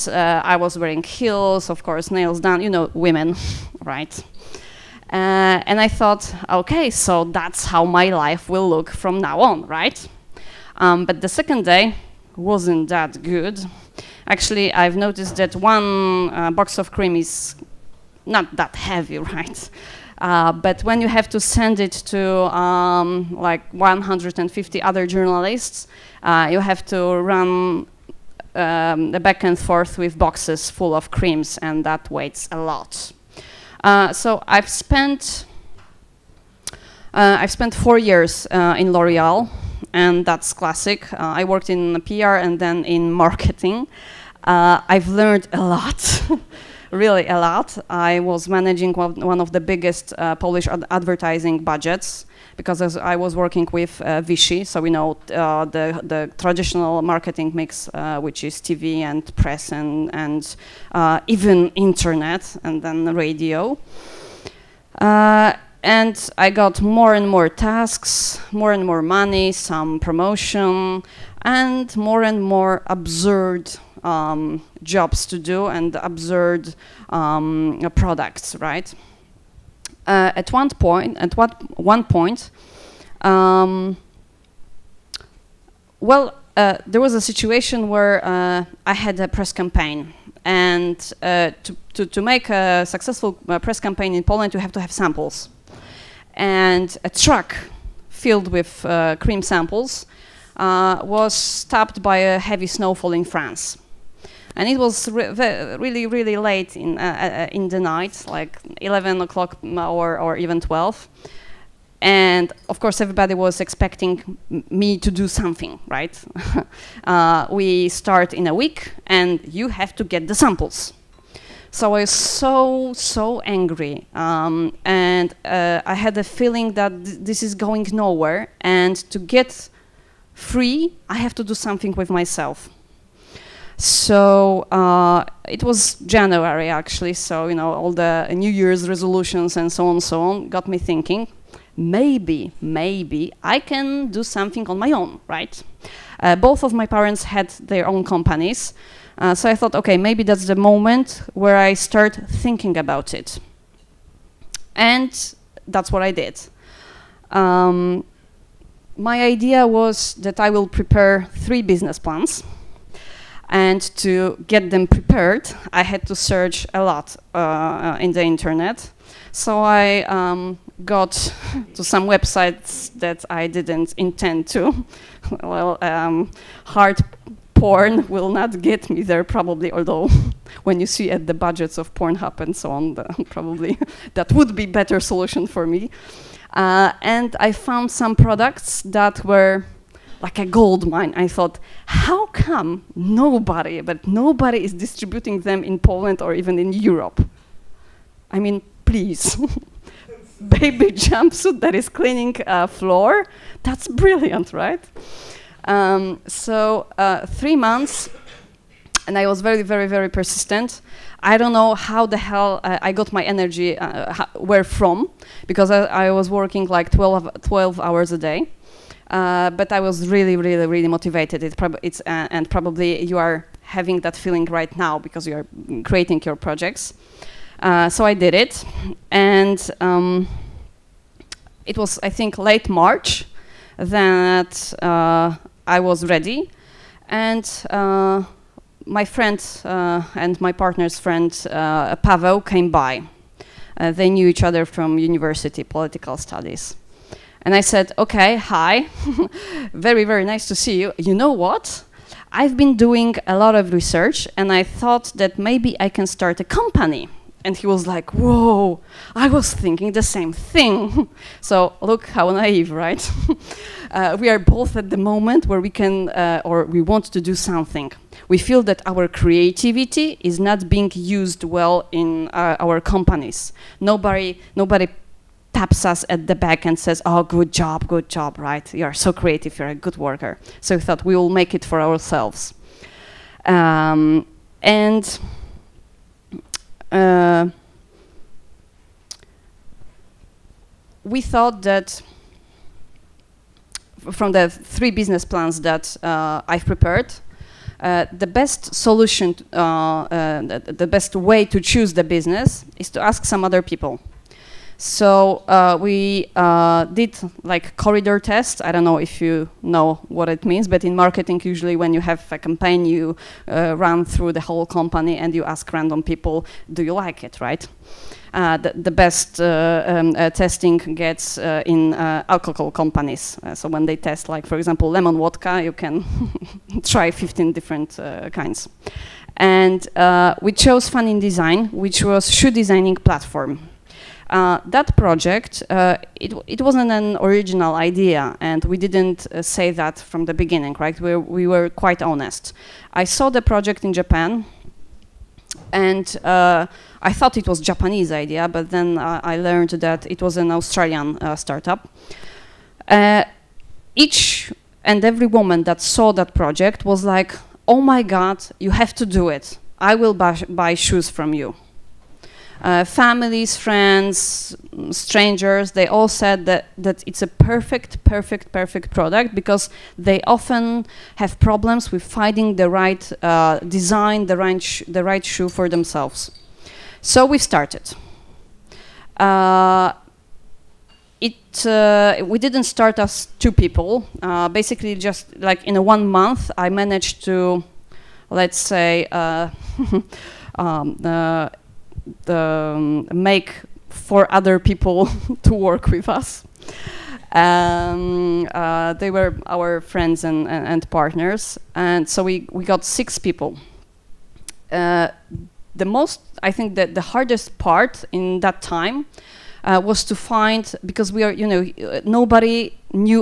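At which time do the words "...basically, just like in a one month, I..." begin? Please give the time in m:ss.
6:24.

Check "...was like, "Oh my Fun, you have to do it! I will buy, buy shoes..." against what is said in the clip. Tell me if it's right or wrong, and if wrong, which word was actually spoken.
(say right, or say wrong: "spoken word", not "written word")
wrong: "God", not "Fun".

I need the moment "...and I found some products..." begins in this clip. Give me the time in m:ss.
3:07.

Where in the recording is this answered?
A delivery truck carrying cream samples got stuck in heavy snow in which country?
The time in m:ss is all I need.
1:43.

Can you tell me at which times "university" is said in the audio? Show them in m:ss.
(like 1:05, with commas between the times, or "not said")
4:04.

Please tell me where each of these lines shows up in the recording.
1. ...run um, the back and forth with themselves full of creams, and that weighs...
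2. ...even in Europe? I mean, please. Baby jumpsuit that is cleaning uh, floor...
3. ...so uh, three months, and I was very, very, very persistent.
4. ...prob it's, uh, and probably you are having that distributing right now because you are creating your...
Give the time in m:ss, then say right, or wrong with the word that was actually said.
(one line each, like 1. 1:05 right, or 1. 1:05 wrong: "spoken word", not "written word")
1. 0:27 wrong: "boxes", not "themselves"
2. 3:16 right
3. 3:26 right
4. 3:41 wrong: "feeling", not "distributing".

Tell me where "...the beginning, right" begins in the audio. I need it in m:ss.
5:40.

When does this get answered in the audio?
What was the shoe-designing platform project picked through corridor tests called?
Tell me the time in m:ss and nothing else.
5:30.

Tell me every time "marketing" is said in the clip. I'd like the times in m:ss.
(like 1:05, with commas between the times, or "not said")
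0:43, 0:57, 5:10.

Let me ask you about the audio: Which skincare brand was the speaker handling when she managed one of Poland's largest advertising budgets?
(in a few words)
Vichy.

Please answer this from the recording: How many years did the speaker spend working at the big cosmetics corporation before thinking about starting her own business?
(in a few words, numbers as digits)
4.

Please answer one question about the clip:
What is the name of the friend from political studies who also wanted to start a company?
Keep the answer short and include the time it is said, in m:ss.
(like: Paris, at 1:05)
Pavel, at 4:01.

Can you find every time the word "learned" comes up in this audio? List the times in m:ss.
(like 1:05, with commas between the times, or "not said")
0:45, 5:49.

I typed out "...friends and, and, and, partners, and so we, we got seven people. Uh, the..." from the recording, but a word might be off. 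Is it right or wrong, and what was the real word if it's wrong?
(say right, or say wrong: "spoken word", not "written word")
wrong: "six", not "seven".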